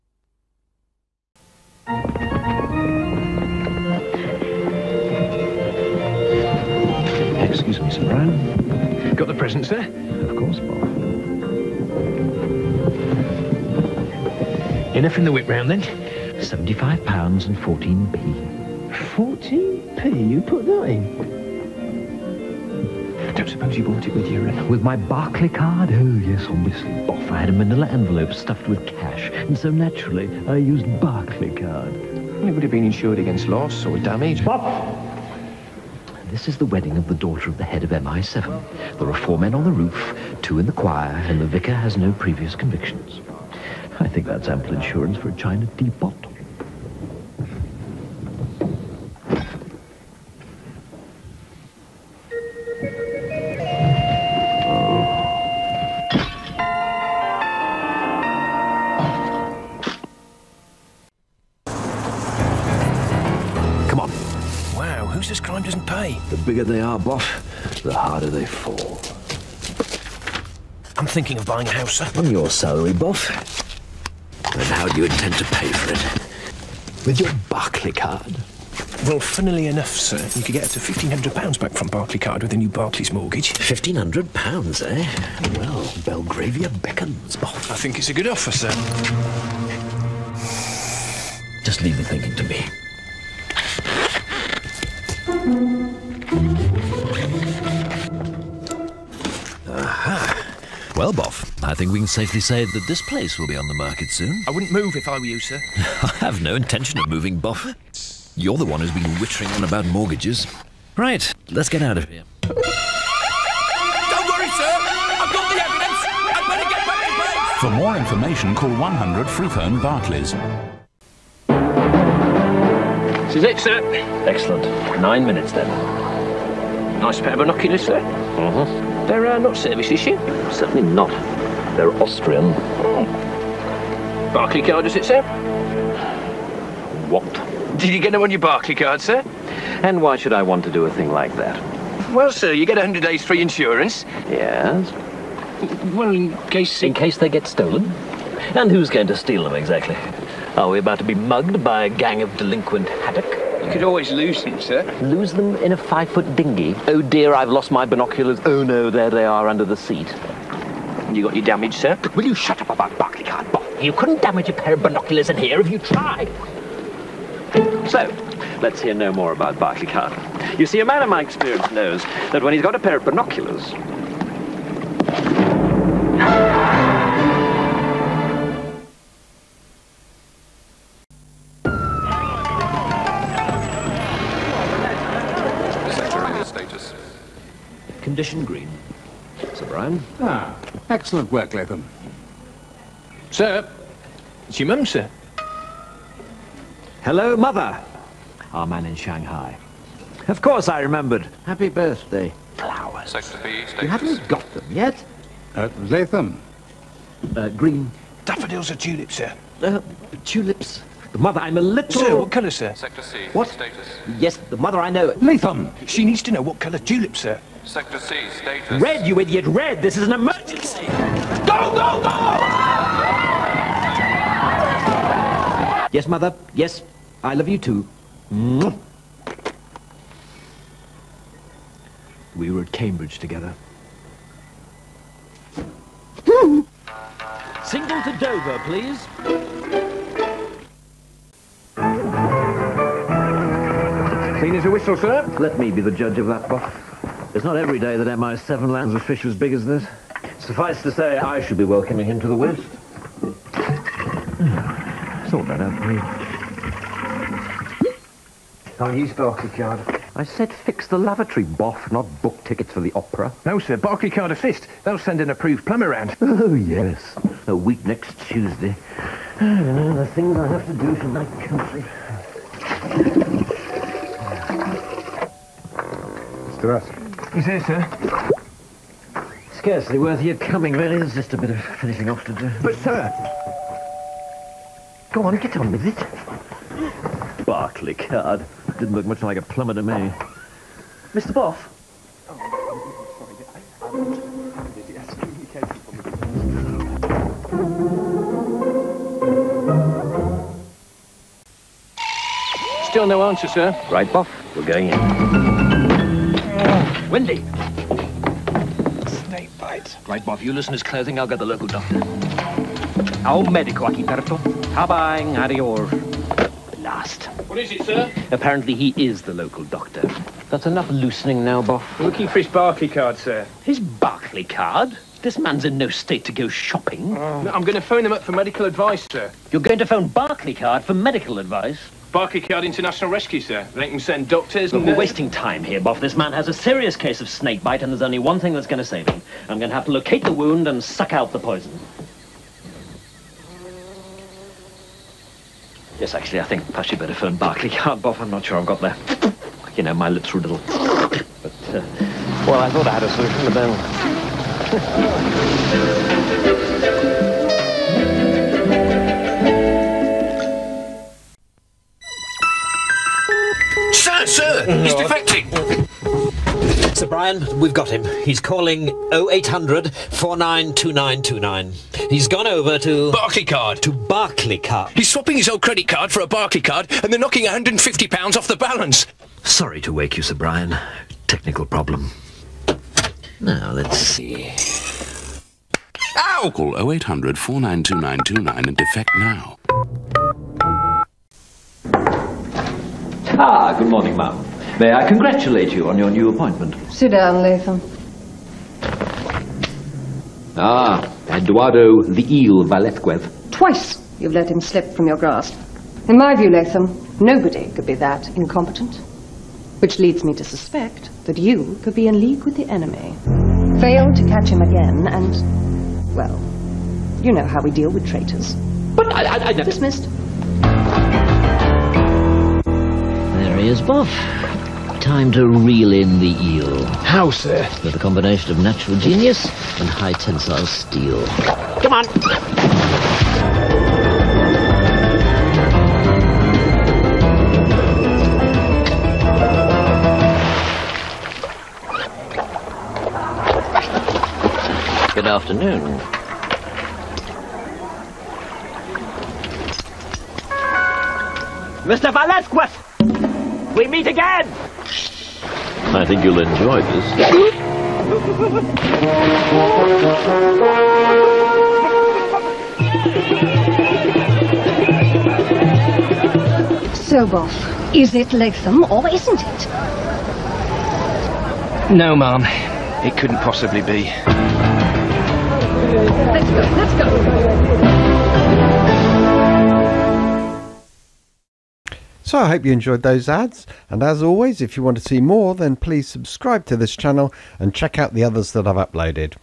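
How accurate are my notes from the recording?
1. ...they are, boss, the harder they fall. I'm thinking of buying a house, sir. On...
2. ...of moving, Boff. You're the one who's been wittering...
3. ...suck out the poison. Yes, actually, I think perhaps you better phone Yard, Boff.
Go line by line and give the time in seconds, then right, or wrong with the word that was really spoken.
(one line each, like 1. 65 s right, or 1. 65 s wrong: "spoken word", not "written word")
1. 66 s right
2. 107 s right
3. 340 s right.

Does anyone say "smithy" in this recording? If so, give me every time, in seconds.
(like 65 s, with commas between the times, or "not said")
not said.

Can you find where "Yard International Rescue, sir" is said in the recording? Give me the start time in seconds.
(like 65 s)
332 s.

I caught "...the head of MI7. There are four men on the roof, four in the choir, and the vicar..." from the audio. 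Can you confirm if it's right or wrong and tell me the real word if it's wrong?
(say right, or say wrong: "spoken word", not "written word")
wrong: "two", not "four".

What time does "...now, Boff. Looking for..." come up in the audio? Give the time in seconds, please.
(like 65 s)
321 s.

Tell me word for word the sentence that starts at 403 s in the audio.
Twice you've let him slip from your grasp.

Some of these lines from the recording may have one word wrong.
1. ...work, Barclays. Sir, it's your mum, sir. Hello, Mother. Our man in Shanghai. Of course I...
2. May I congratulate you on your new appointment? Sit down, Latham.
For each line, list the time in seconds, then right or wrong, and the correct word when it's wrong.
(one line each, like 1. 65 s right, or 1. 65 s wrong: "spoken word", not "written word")
1. 191 s wrong: "Latham", not "Barclays"
2. 394 s right.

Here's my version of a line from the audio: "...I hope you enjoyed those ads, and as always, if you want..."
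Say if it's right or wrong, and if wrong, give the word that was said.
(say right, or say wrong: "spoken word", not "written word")
right.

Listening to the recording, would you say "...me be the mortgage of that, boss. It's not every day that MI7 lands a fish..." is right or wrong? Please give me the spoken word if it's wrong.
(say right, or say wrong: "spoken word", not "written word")
wrong: "judge", not "mortgage".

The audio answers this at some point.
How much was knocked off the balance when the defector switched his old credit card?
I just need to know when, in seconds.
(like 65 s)
377 s.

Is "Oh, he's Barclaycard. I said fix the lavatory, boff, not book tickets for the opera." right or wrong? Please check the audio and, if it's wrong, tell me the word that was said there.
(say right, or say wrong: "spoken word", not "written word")
right.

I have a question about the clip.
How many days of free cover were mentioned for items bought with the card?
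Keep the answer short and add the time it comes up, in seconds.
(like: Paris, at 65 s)
100, at 142 s.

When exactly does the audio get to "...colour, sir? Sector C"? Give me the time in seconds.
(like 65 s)
212 s.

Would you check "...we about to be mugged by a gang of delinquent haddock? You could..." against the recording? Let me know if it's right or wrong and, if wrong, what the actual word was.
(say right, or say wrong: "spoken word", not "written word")
right.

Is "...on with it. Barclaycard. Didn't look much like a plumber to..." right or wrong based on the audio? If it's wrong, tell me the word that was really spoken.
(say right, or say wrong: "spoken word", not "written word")
right.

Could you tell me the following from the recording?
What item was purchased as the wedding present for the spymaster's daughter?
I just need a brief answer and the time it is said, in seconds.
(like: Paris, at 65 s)
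A china teapot, at 45 s.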